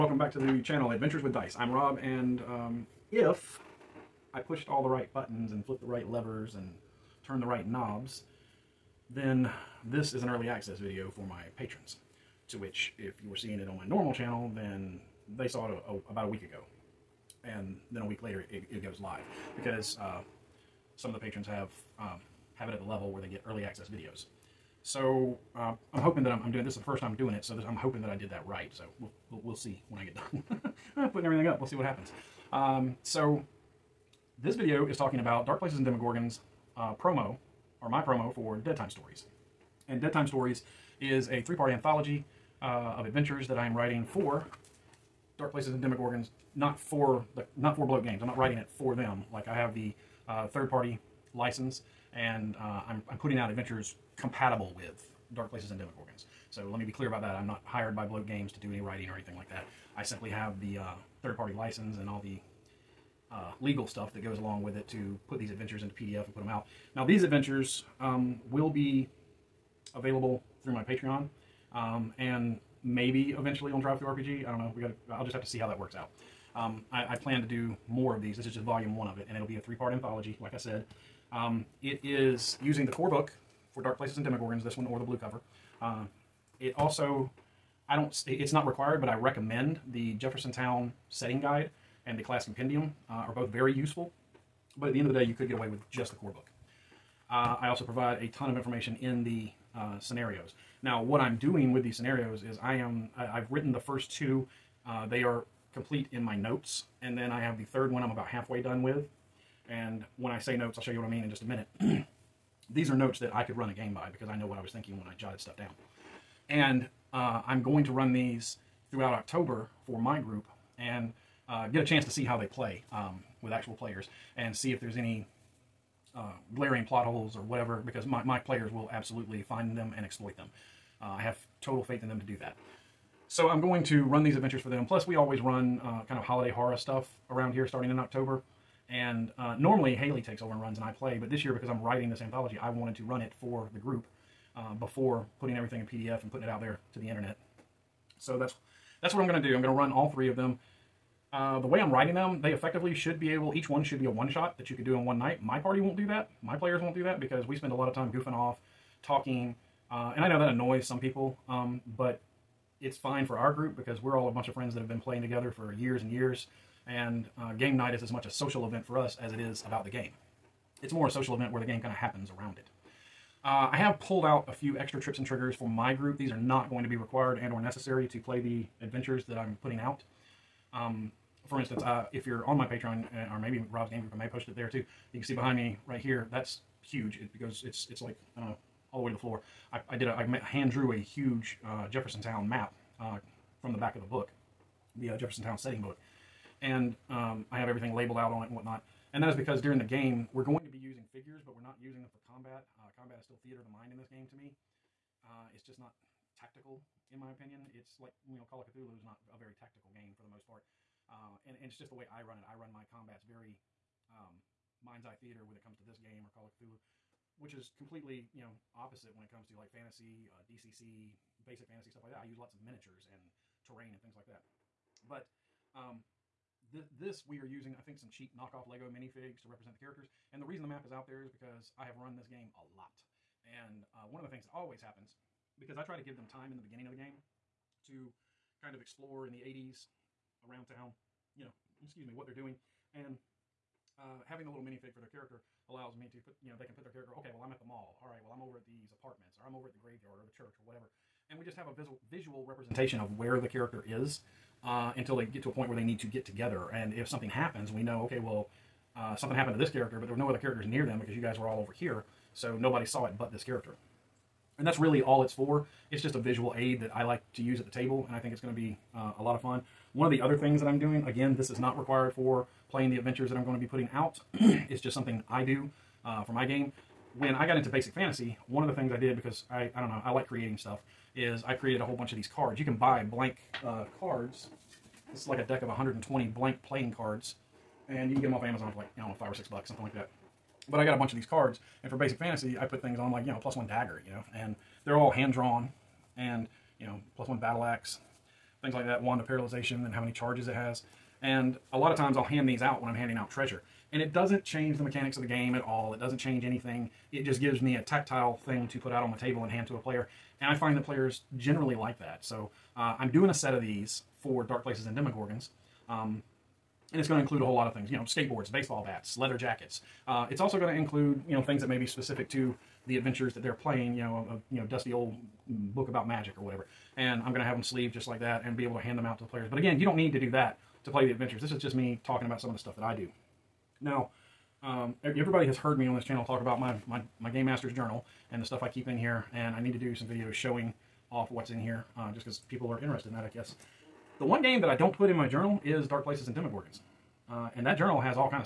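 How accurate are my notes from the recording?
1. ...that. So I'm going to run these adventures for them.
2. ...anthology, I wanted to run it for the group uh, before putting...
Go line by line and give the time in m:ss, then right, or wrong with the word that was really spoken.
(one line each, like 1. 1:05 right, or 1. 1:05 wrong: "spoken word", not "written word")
1. 2:12 right
2. 2:22 right.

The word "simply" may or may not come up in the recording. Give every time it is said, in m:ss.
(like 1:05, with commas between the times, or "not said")
1:00.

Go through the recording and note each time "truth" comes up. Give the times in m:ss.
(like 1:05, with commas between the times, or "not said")
not said.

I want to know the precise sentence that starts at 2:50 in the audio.
It's more a social event where the game kind of happens around it.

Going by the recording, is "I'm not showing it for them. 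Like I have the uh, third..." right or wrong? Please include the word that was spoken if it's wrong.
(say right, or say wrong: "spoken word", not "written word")
wrong: "writing", not "showing".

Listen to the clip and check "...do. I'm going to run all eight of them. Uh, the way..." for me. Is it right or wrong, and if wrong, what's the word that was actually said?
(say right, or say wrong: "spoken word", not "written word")
wrong: "three", not "eight".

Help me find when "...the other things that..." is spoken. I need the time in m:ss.
4:30.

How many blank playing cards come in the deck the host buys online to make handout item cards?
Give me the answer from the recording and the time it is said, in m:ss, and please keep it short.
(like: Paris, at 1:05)
120, at 4:45.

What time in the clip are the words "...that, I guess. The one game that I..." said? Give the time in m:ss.
5:43.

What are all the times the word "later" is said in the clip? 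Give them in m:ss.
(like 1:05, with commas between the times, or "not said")
0:18.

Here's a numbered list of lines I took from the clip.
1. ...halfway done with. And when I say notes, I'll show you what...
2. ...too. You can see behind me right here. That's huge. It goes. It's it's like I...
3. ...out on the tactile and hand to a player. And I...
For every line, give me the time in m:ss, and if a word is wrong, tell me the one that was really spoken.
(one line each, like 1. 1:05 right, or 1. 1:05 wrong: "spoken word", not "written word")
1. 1:48 right
2. 3:04 right
3. 5:08 wrong: "table", not "tactile".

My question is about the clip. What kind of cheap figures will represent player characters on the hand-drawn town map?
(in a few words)
knockoff Lego minifigs.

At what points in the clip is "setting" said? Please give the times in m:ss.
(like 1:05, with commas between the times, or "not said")
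1:31, 3:15.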